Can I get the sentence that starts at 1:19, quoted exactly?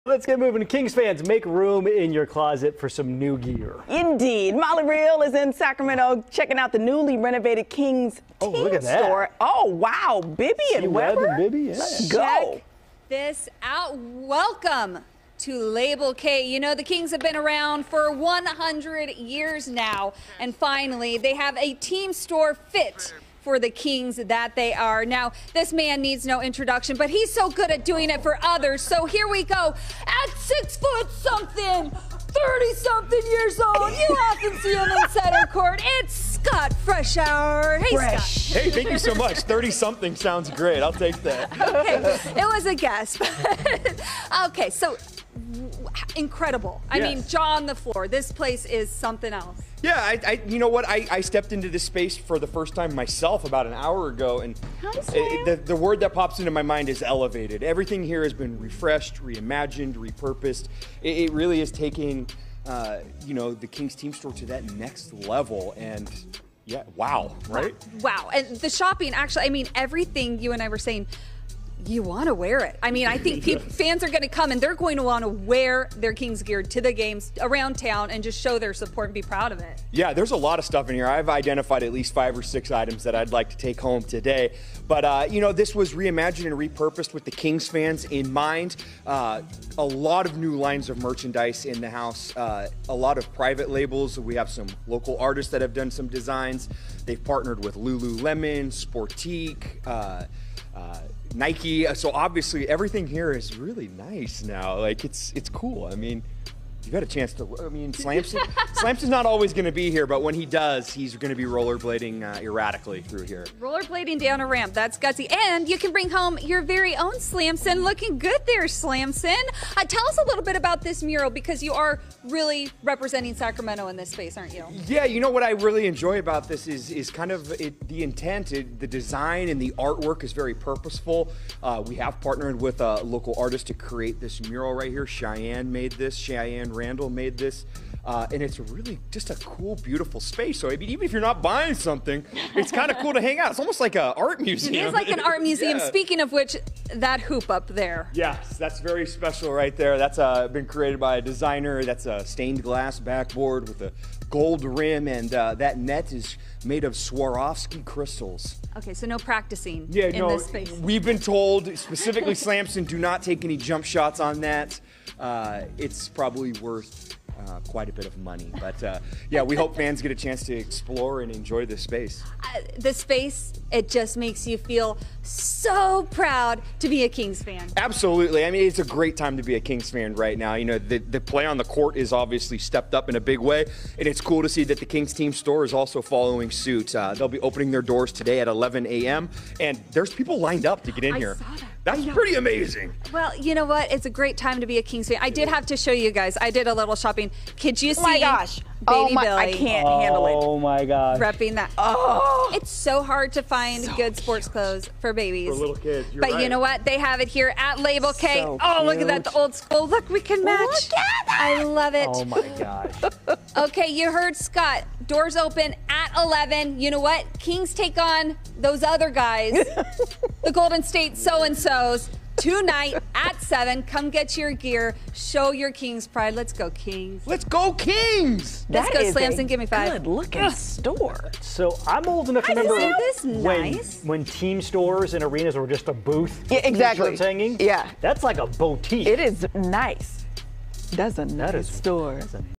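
Yeah, there's a lot of stuff in here.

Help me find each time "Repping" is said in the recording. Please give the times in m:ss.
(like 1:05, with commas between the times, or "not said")
3:21.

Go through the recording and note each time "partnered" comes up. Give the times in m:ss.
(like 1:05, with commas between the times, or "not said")
1:37, 2:12.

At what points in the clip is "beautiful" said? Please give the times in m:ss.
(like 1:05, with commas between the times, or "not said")
2:19.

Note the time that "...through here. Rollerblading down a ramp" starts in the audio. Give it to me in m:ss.
1:53.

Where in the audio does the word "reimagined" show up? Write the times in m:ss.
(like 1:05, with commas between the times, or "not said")
0:59, 1:25.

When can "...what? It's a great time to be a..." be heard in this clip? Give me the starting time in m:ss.
3:13.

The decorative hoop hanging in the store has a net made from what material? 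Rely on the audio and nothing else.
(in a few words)
Swarovski crystals.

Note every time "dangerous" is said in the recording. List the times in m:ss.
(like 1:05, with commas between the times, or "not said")
not said.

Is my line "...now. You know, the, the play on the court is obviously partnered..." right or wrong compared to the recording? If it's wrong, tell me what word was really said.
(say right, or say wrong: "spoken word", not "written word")
wrong: "stepped", not "partnered".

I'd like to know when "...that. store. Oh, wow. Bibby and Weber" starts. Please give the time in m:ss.
0:08.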